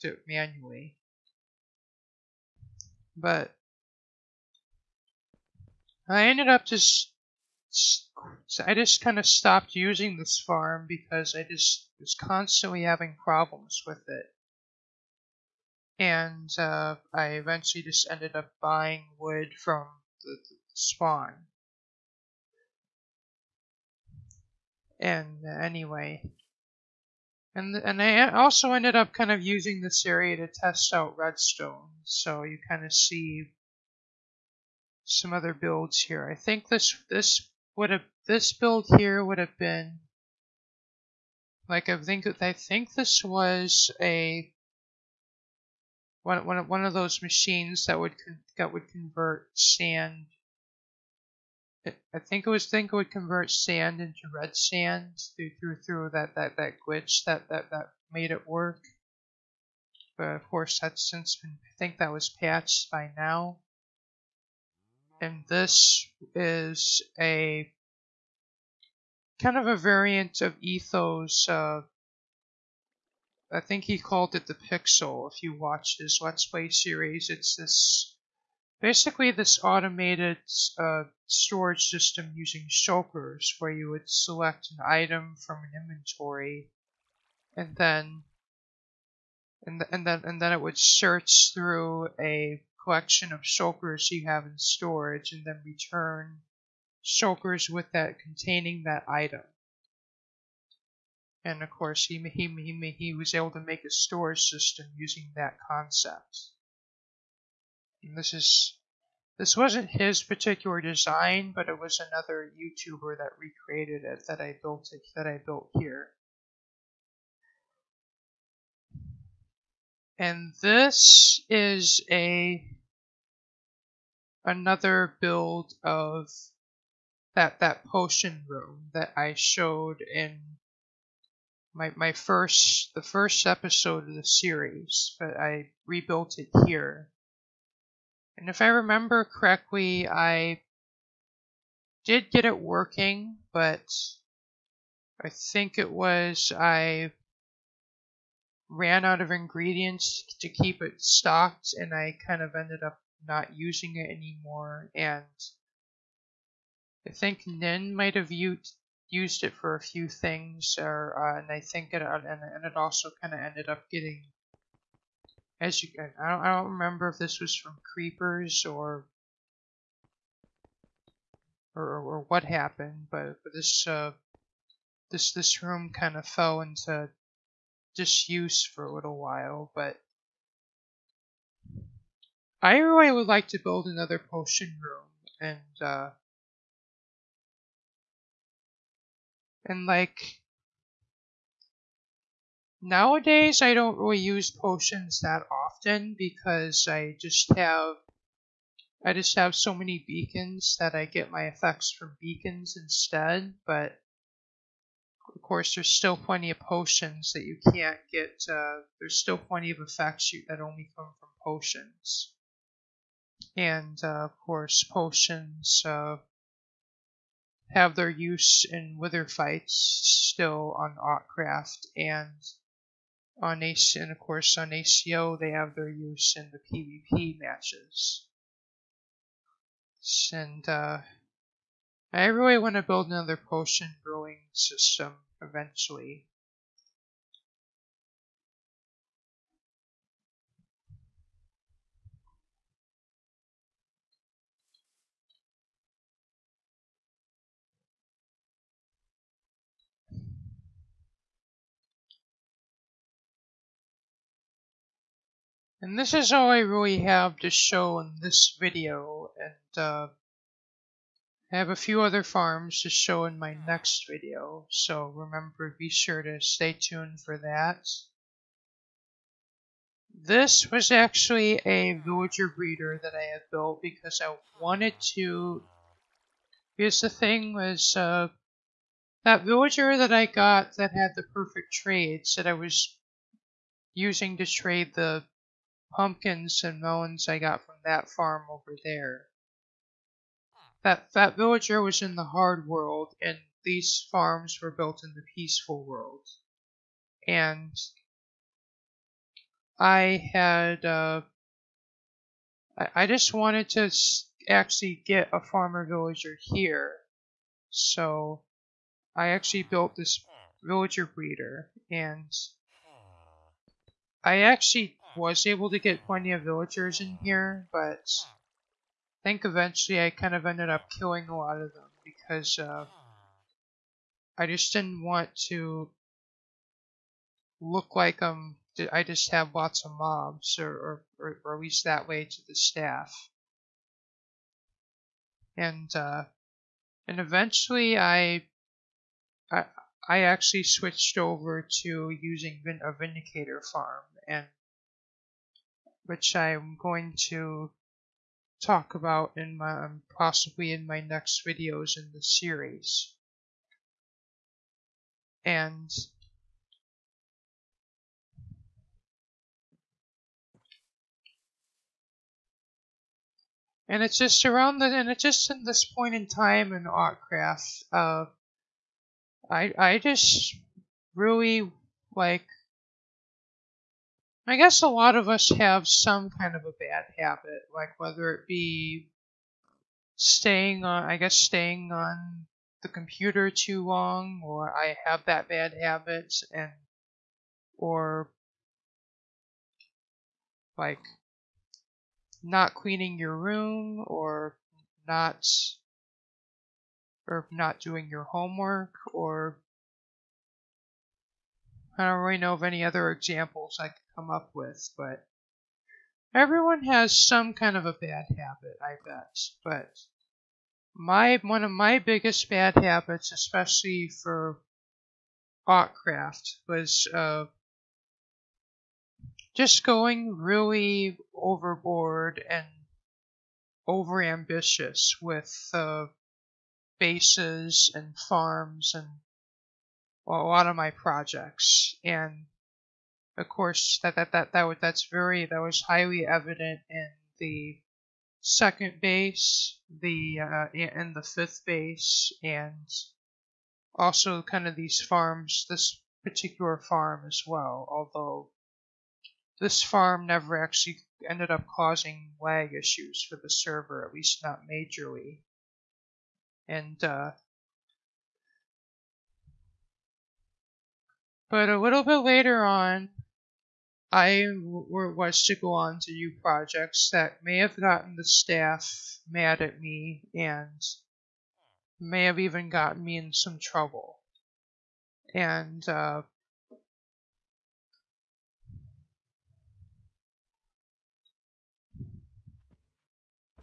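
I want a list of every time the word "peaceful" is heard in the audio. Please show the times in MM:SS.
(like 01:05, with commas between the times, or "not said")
04:55.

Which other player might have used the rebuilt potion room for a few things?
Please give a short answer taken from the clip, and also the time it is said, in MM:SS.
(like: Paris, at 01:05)
Nin, at 02:37.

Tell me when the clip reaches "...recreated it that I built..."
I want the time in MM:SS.
01:53.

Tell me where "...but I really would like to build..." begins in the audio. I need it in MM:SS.
02:59.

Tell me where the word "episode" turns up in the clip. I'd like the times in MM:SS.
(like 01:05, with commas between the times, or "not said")
02:13.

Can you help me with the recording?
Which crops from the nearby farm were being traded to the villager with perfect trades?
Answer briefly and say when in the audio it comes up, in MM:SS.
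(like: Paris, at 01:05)
Pumpkins and melons, at 04:45.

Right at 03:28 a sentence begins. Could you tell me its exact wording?
Uh, there's still plenty of effects you, that only come from potions.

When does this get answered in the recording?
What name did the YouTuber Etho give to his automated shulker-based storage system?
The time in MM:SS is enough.
01:14.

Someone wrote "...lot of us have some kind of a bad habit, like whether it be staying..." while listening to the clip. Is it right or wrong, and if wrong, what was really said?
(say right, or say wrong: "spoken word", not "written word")
right.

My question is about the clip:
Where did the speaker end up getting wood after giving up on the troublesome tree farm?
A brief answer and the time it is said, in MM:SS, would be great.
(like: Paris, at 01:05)
The spawn, at 00:20.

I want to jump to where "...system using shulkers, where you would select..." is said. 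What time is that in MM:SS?
01:21.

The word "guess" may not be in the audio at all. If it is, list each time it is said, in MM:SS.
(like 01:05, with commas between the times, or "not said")
06:14, 06:21.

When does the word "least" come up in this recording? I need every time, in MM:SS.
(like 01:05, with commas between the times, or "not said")
05:31, 07:34.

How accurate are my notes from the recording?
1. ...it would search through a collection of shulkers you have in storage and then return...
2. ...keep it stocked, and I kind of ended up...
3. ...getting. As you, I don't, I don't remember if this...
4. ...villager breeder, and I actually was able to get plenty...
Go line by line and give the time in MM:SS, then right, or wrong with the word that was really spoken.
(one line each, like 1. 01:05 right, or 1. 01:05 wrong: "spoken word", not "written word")
1. 01:30 right
2. 02:30 right
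3. 02:43 right
4. 05:10 right.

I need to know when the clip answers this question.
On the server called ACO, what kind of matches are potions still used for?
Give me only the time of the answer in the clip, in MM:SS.
03:47.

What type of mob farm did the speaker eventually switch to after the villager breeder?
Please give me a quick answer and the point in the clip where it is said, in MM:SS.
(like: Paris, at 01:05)
Vindicator farm, at 05:42.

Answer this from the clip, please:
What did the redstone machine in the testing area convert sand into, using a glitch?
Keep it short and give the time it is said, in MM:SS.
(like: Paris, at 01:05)
Red sand, at 00:54.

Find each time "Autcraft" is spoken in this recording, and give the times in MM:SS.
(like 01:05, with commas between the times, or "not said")
03:40, 06:06.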